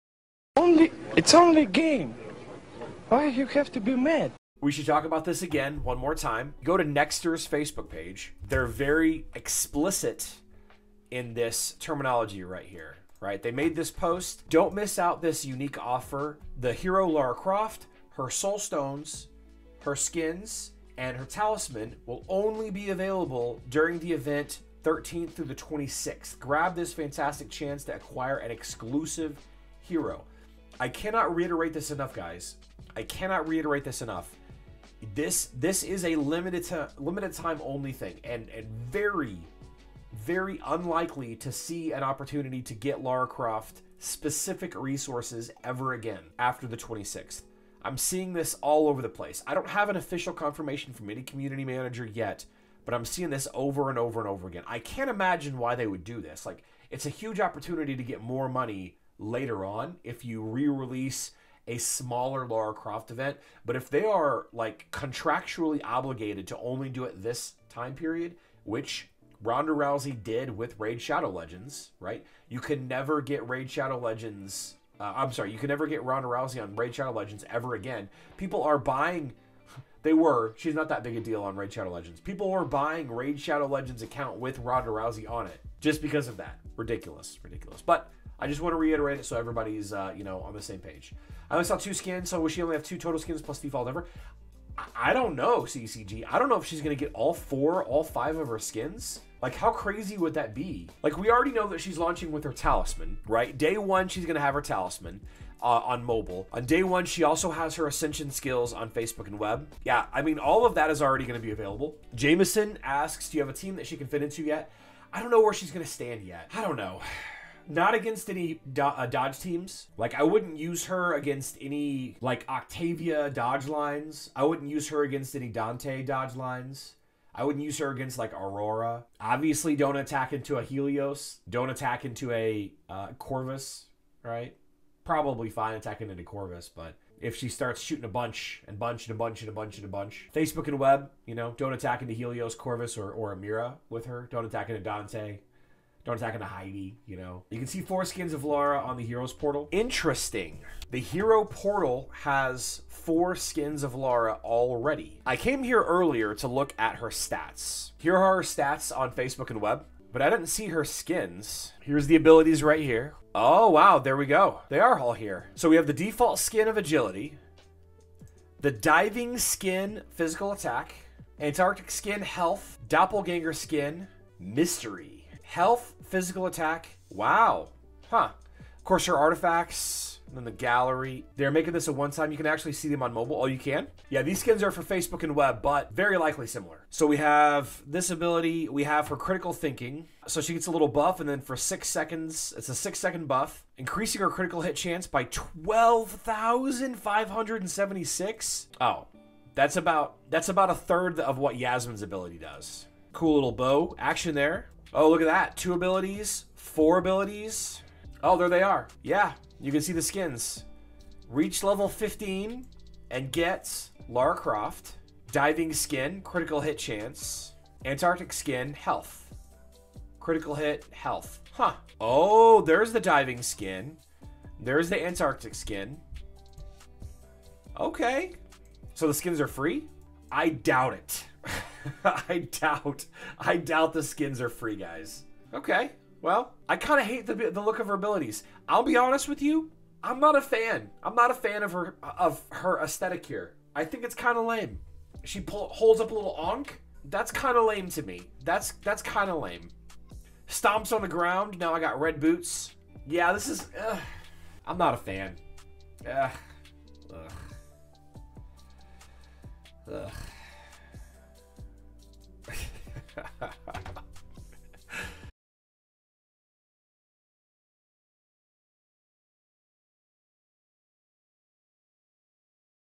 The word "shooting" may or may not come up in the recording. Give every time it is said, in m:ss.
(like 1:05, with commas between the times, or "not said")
2:17.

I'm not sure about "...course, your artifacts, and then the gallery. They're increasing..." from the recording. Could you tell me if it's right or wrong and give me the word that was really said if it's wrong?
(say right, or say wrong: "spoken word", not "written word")
wrong: "making", not "increasing".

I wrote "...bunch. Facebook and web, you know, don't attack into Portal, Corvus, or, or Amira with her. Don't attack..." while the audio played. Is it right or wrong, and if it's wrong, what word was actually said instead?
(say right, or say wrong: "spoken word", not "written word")
wrong: "Helios", not "Portal".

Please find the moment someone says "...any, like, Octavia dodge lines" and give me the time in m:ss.
2:01.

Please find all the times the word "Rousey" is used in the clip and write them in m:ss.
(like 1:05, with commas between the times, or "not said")
1:09, 1:16, 1:24.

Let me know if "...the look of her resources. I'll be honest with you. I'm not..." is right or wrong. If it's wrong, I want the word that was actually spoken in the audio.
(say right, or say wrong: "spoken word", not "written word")
wrong: "abilities", not "resources".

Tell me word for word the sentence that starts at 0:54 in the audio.
I can't imagine why they would do this.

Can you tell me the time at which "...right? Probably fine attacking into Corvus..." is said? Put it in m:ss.
2:14.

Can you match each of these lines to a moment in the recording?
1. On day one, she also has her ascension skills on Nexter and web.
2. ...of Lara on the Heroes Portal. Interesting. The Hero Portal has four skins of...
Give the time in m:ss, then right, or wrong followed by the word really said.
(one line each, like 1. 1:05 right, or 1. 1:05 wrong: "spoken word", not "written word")
1. 1:46 wrong: "Facebook", not "Nexter"
2. 2:28 right.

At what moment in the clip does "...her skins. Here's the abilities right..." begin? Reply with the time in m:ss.
2:40.